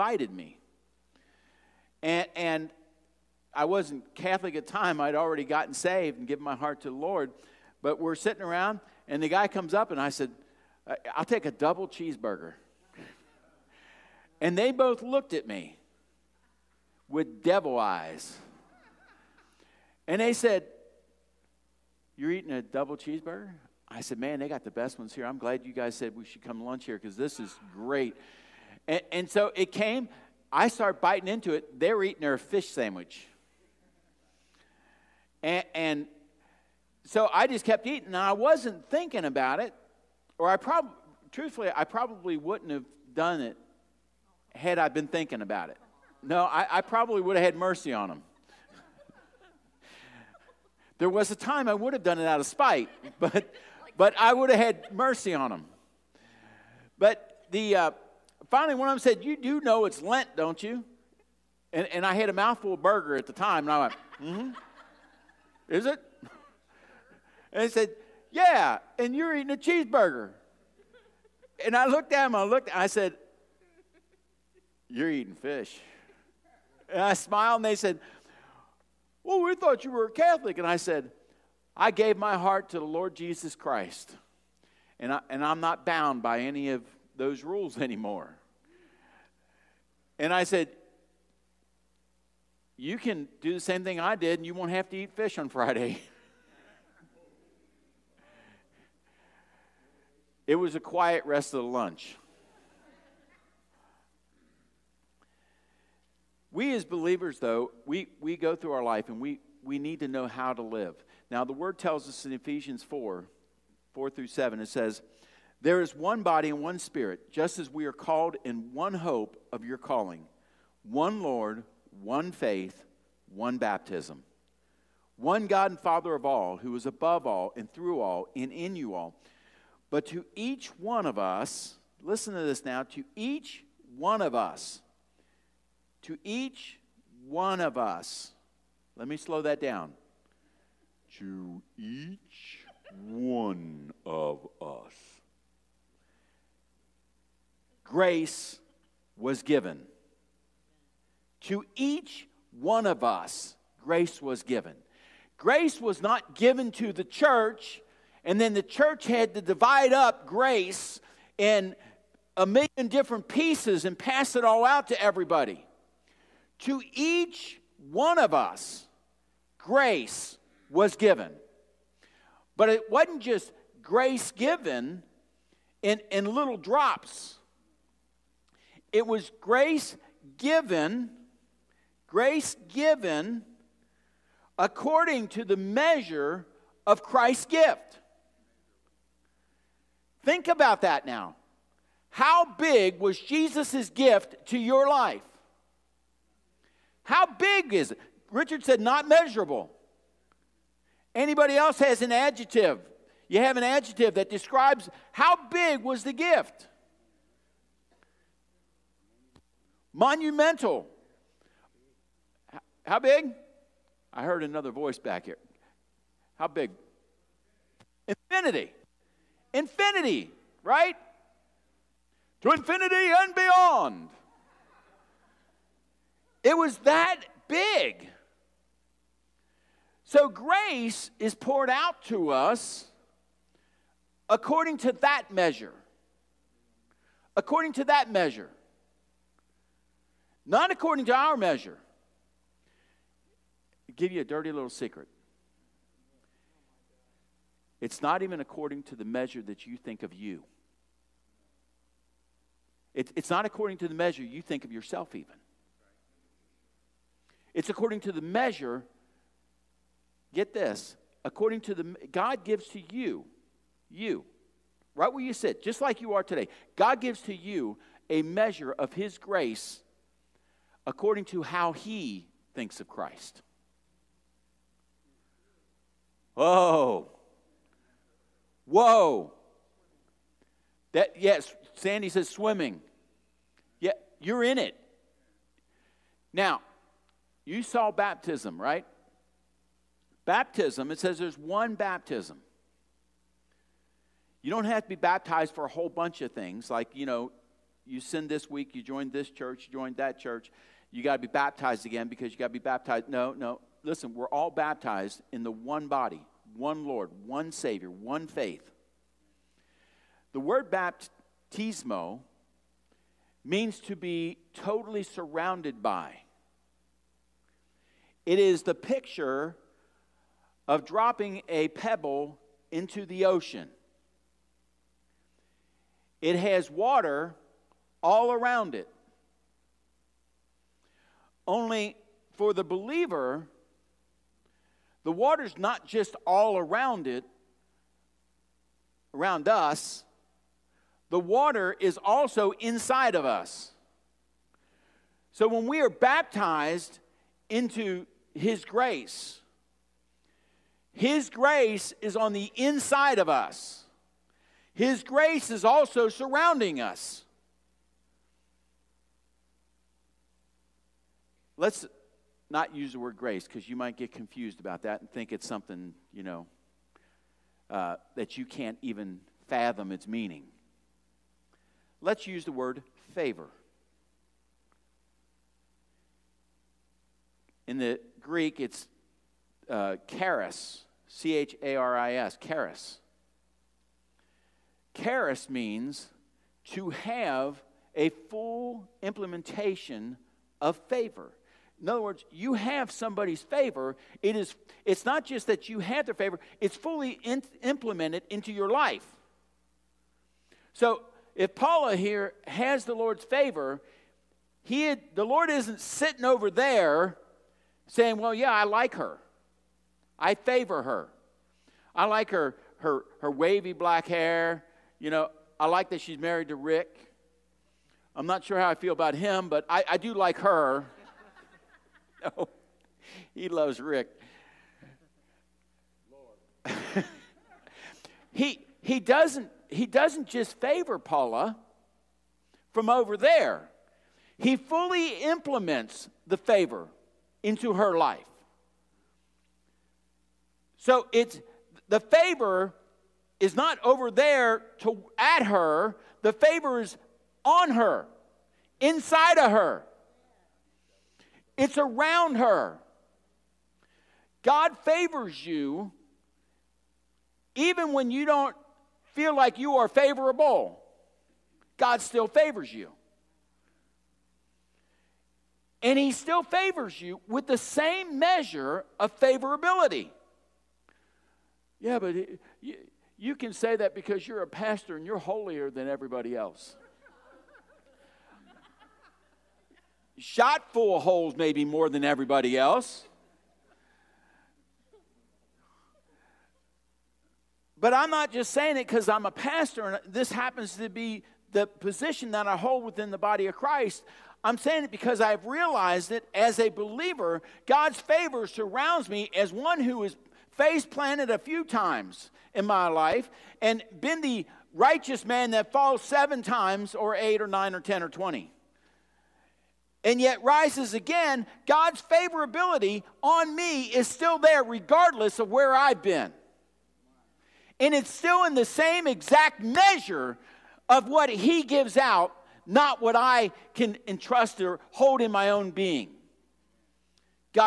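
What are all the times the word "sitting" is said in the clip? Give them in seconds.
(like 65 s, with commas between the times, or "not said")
8 s, 405 s.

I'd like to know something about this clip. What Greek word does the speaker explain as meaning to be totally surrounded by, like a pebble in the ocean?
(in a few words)
Baptismo.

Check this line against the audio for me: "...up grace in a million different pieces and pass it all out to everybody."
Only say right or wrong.
right.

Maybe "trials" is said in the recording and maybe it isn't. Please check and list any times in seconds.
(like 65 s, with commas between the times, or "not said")
not said.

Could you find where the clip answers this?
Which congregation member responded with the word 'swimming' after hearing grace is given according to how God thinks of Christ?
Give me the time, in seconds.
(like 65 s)
281 s.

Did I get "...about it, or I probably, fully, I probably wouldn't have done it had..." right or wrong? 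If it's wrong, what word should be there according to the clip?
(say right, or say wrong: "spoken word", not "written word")
wrong: "truthfully", not "fully".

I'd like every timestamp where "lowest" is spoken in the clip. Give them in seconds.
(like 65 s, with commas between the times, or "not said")
not said.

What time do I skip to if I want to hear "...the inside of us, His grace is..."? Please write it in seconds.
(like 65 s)
352 s.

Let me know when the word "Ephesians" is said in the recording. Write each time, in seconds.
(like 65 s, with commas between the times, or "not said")
112 s.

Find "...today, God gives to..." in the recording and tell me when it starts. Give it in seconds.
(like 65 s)
266 s.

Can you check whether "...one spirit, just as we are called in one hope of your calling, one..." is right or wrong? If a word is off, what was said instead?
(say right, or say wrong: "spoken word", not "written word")
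right.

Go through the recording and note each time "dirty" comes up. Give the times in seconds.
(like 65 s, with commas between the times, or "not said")
244 s.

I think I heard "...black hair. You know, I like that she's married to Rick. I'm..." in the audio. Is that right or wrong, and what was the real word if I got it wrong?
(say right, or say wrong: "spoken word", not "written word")
right.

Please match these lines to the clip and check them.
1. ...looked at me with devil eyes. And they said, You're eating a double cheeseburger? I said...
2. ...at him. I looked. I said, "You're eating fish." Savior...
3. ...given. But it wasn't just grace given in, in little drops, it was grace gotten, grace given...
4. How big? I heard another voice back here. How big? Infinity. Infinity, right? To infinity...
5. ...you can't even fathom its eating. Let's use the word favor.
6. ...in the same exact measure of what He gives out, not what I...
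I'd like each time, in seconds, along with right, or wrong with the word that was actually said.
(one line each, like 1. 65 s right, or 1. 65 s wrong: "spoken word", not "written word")
1. 15 s right
2. 72 s wrong: "And", not "Savior"
3. 170 s wrong: "given", not "gotten"
4. 212 s right
5. 368 s wrong: "meaning", not "eating"
6. 518 s right.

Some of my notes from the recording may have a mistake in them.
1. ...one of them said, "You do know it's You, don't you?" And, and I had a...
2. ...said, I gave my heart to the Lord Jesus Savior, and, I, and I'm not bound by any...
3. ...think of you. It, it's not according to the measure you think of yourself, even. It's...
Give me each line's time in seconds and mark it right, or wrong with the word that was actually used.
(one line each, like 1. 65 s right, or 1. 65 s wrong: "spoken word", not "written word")
1. 58 s wrong: "Lent", not "You"
2. 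80 s wrong: "Christ", not "Savior"
3. 249 s right.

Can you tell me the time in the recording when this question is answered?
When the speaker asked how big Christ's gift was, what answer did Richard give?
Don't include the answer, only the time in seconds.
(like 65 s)
198 s.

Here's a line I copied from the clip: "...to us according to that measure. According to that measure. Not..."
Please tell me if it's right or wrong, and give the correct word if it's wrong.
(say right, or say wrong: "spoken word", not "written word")
right.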